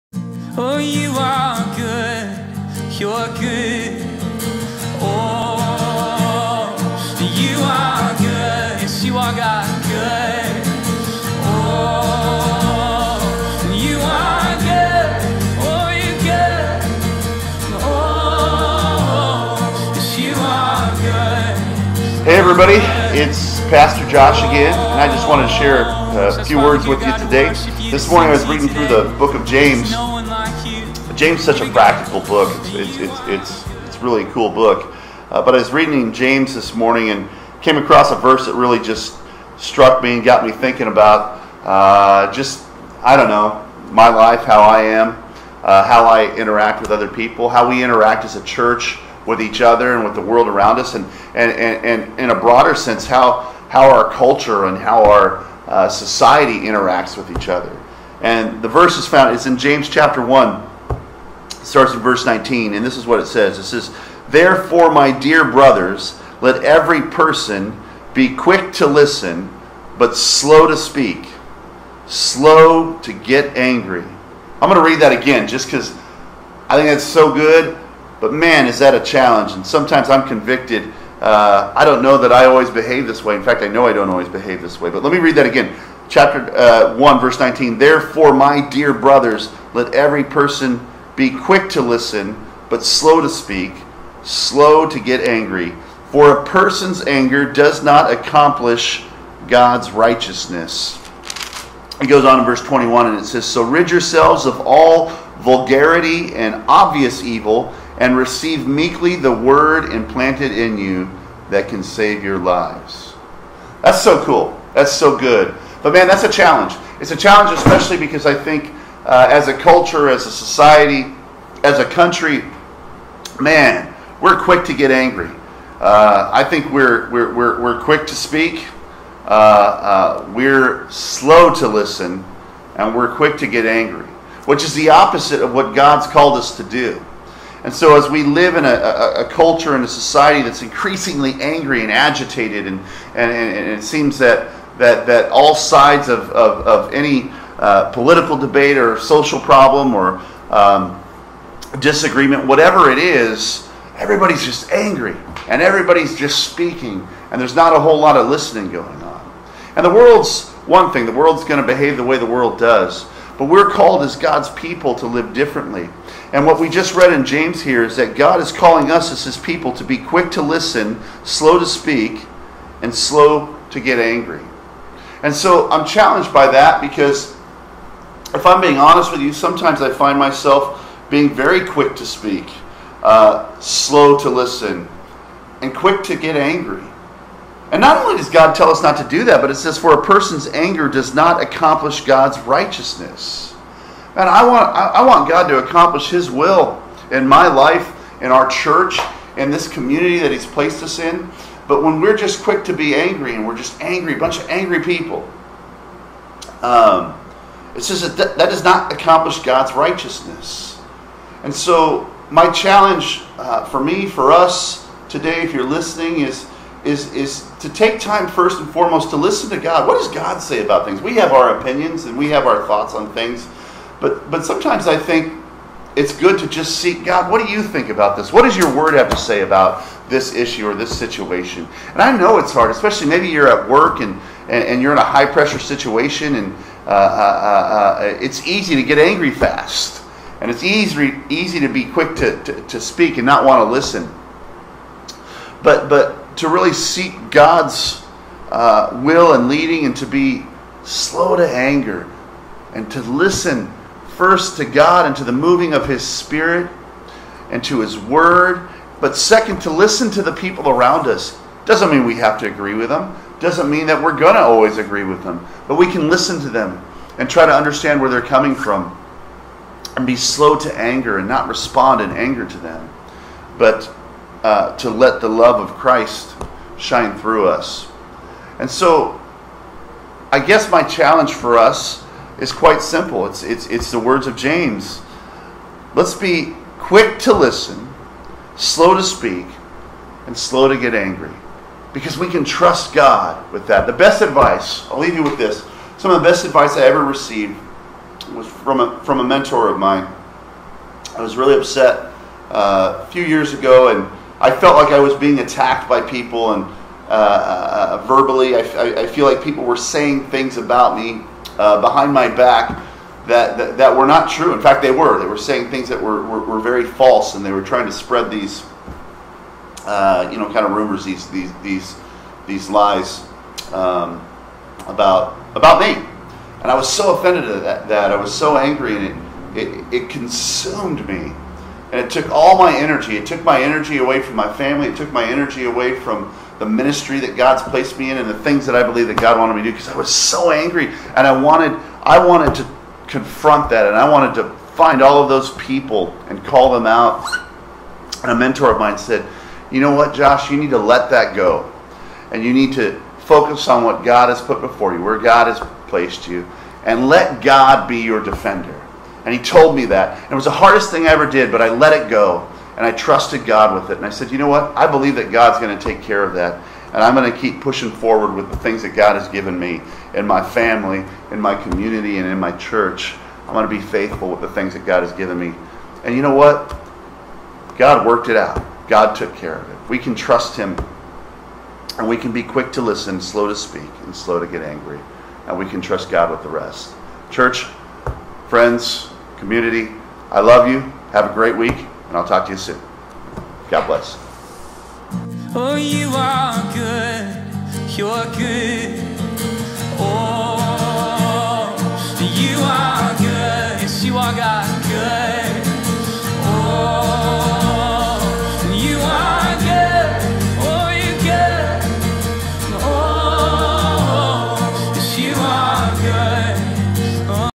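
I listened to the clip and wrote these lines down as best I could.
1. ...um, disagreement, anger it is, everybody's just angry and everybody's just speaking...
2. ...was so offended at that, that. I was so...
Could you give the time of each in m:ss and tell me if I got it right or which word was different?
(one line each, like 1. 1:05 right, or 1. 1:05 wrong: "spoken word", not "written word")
1. 2:30 wrong: "whatever", not "anger"
2. 5:26 right.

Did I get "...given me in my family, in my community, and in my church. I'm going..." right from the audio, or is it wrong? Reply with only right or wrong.
right.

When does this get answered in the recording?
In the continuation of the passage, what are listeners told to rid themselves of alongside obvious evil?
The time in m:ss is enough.
1:45.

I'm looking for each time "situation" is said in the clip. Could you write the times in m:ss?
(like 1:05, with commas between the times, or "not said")
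3:50, 3:55.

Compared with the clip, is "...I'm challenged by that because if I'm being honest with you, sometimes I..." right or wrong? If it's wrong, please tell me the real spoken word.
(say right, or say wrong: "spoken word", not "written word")
right.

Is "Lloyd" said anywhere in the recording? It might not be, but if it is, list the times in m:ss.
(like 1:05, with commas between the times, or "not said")
not said.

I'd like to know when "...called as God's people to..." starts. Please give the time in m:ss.
2:43.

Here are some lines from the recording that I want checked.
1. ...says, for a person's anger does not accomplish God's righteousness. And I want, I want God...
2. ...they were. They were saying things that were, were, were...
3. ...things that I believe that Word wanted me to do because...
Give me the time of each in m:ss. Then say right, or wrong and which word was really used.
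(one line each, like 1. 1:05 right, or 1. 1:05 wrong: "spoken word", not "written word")
1. 3:09 right
2. 5:14 right
3. 5:38 wrong: "God", not "Word".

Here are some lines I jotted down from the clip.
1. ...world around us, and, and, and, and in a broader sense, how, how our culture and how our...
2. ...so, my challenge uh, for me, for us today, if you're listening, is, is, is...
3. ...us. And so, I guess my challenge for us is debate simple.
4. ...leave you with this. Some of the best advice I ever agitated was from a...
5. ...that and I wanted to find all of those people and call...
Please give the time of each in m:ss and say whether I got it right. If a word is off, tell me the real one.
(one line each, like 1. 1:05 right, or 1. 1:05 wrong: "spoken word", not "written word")
1. 0:50 right
2. 3:31 right
3. 4:37 wrong: "quite", not "debate"
4. 4:54 wrong: "received", not "agitated"
5. 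5:43 right.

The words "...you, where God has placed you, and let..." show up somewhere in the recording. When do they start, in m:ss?
5:54.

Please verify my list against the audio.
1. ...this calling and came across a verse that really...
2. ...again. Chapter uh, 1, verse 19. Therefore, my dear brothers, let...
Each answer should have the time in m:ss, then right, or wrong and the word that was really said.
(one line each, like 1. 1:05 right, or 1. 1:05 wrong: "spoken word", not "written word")
1. 0:36 wrong: "morning", not "calling"
2. 1:25 right.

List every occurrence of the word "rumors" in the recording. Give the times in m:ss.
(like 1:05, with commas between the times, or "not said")
5:20.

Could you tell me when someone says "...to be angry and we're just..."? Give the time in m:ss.
3:22.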